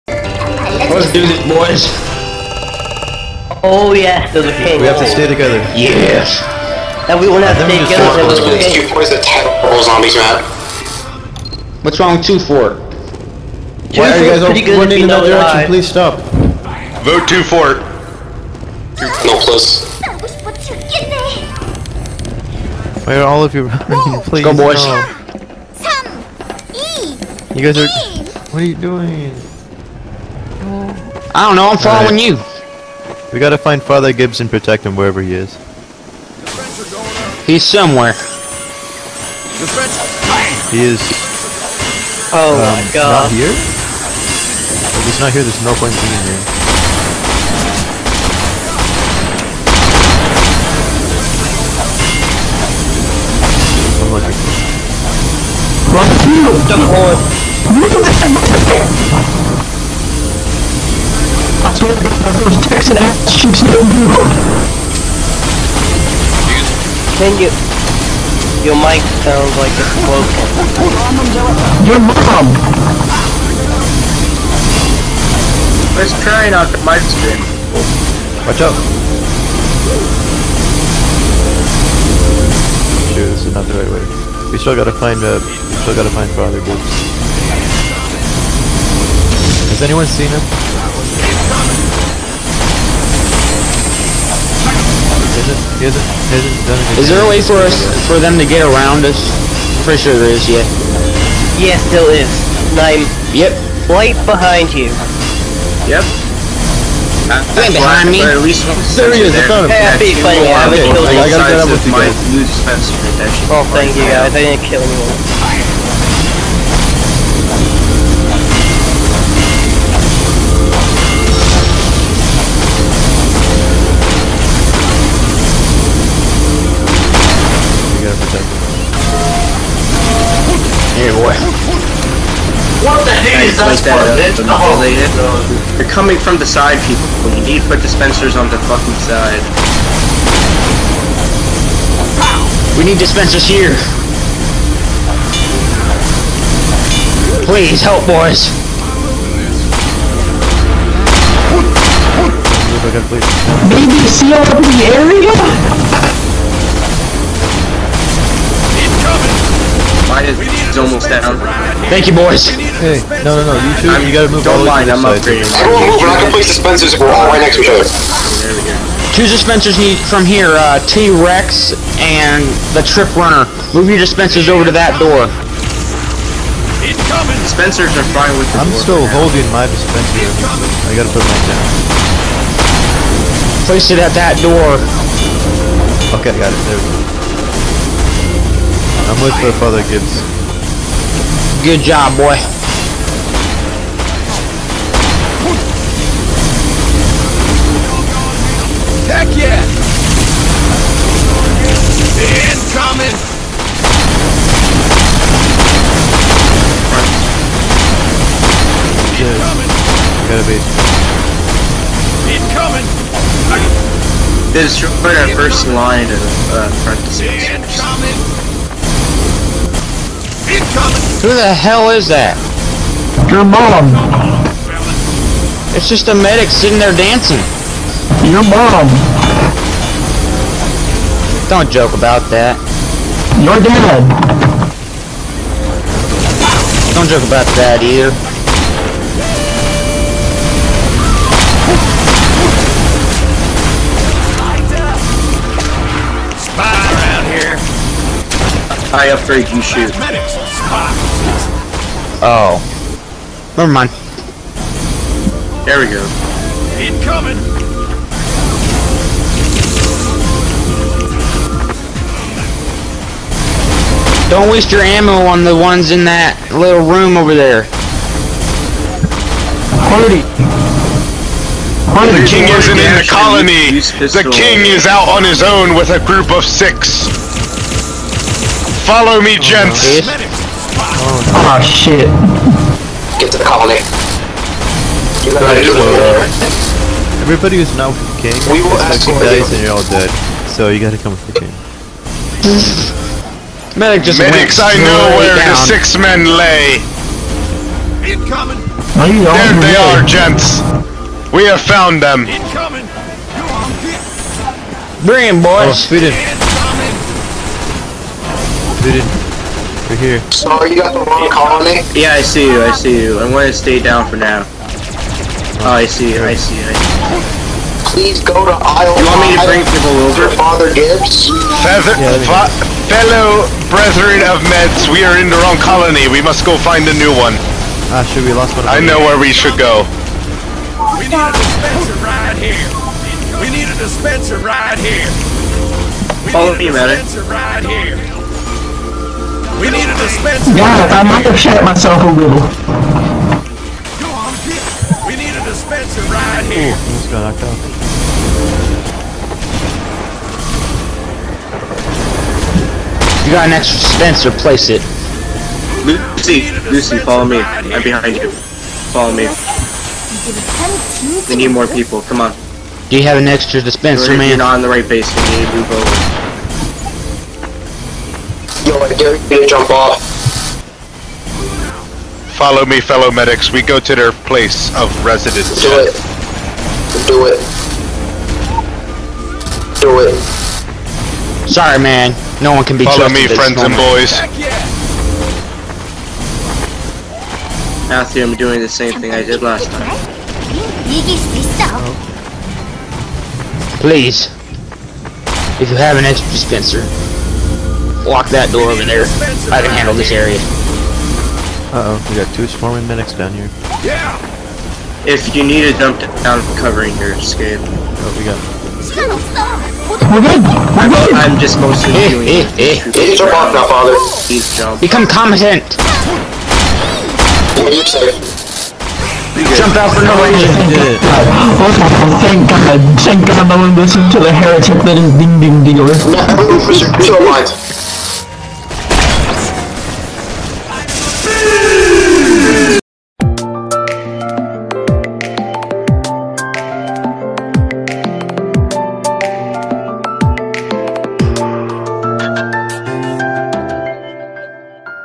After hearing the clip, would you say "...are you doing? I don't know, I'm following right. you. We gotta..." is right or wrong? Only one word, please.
right.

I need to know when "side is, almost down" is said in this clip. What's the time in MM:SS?
02:40.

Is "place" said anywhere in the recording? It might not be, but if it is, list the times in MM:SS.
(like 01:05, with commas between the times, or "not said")
02:46, 03:03, 05:54, 06:14.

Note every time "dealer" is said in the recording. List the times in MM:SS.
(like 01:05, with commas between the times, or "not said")
07:05.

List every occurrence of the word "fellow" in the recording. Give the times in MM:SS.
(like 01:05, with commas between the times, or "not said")
05:22, 06:12.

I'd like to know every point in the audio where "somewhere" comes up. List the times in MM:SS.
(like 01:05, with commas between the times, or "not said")
00:37.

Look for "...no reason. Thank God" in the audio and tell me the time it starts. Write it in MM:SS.
07:00.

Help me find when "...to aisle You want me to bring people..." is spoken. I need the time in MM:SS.
05:18.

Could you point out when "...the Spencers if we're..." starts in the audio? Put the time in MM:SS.
02:46.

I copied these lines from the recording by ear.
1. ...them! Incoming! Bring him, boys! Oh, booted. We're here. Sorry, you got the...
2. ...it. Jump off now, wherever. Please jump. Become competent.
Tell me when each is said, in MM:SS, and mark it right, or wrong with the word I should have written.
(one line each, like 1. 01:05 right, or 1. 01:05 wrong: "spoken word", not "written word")
1. 05:02 right
2. 06:52 wrong: "father", not "wherever".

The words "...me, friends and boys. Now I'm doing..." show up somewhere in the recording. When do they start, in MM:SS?
06:23.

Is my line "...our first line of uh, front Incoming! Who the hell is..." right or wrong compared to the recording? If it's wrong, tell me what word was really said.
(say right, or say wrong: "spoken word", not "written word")
right.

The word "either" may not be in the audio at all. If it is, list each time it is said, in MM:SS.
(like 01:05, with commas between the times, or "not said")
03:57.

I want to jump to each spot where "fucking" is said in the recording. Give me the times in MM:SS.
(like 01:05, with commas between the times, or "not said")
02:18.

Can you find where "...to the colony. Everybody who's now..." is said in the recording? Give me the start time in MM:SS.
04:43.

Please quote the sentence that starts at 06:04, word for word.
You're not on the right base, we need to move over jump off.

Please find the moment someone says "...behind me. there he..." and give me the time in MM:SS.
01:47.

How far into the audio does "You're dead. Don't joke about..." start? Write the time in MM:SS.
03:53.